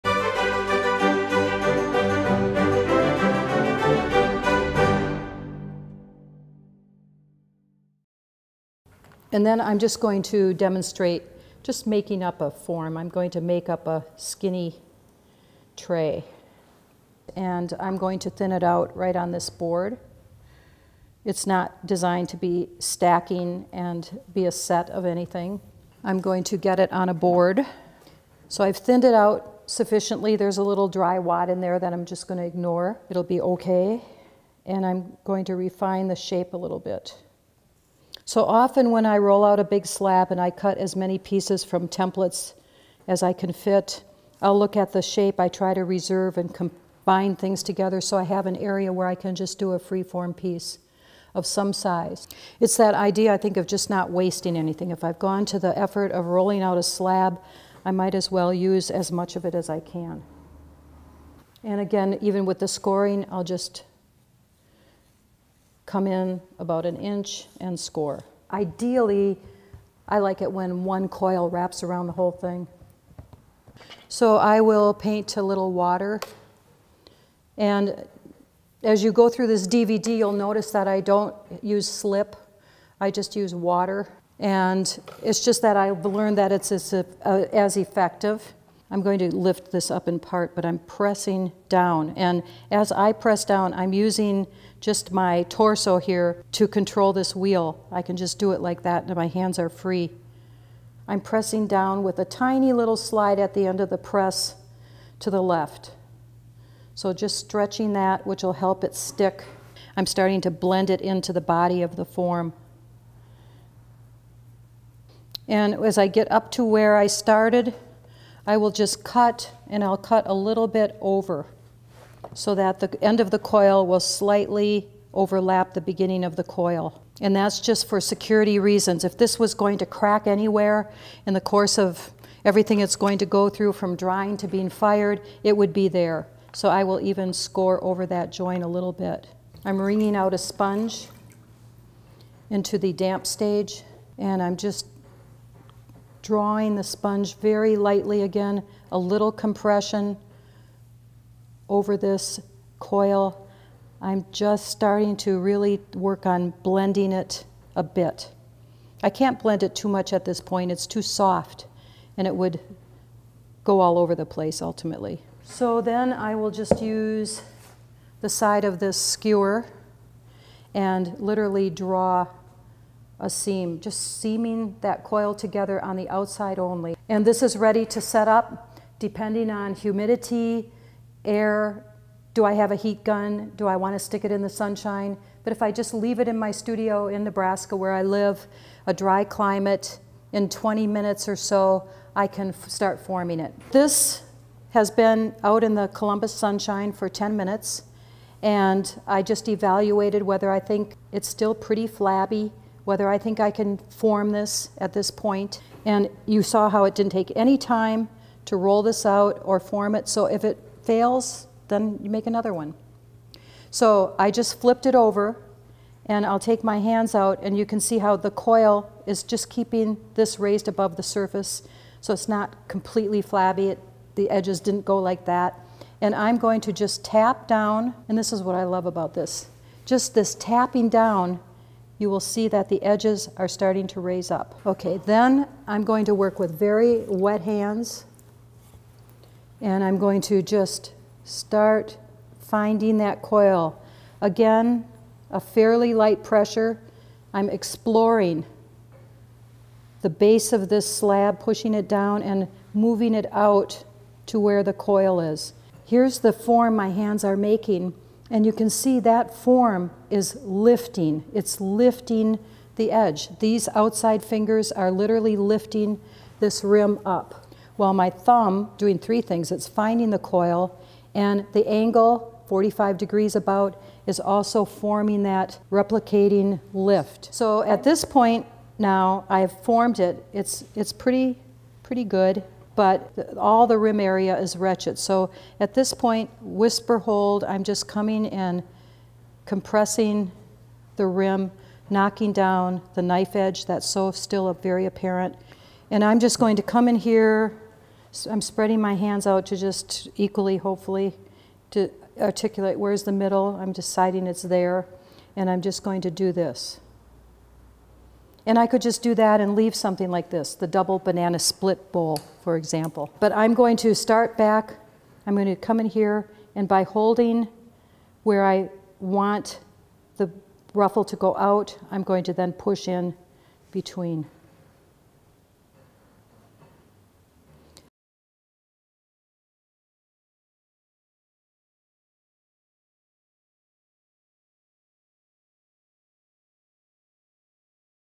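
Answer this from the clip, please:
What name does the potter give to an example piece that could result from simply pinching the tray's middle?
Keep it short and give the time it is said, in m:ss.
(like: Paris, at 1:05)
double banana split bowl, at 5:10.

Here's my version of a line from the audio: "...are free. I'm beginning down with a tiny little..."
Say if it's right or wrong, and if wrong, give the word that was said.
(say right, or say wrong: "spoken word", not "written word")
wrong: "pressing", not "beginning".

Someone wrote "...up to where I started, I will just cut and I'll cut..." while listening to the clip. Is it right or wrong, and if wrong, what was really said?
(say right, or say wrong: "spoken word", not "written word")
right.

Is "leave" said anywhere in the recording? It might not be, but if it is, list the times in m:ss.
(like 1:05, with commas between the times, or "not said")
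3:05, 5:09.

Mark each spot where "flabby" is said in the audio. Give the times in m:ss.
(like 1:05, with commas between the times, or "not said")
3:21, 3:43.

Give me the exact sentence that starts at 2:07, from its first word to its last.
And that's just for security reasons.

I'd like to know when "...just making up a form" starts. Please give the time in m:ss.
0:11.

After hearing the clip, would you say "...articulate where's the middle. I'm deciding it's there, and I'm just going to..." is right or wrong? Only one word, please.
right.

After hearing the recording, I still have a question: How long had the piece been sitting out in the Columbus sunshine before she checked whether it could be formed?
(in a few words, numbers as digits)
10 minutes.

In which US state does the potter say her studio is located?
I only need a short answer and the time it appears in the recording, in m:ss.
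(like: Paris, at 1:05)
Nebraska, at 3:07.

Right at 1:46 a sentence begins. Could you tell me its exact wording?
So just stretching that, which will help it stick.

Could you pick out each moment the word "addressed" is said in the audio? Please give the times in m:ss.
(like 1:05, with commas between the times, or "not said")
not said.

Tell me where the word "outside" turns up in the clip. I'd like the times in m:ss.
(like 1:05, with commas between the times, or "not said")
2:56, 4:23.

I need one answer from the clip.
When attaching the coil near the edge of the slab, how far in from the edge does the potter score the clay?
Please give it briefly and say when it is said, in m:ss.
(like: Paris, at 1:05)
about an inch, at 1:06.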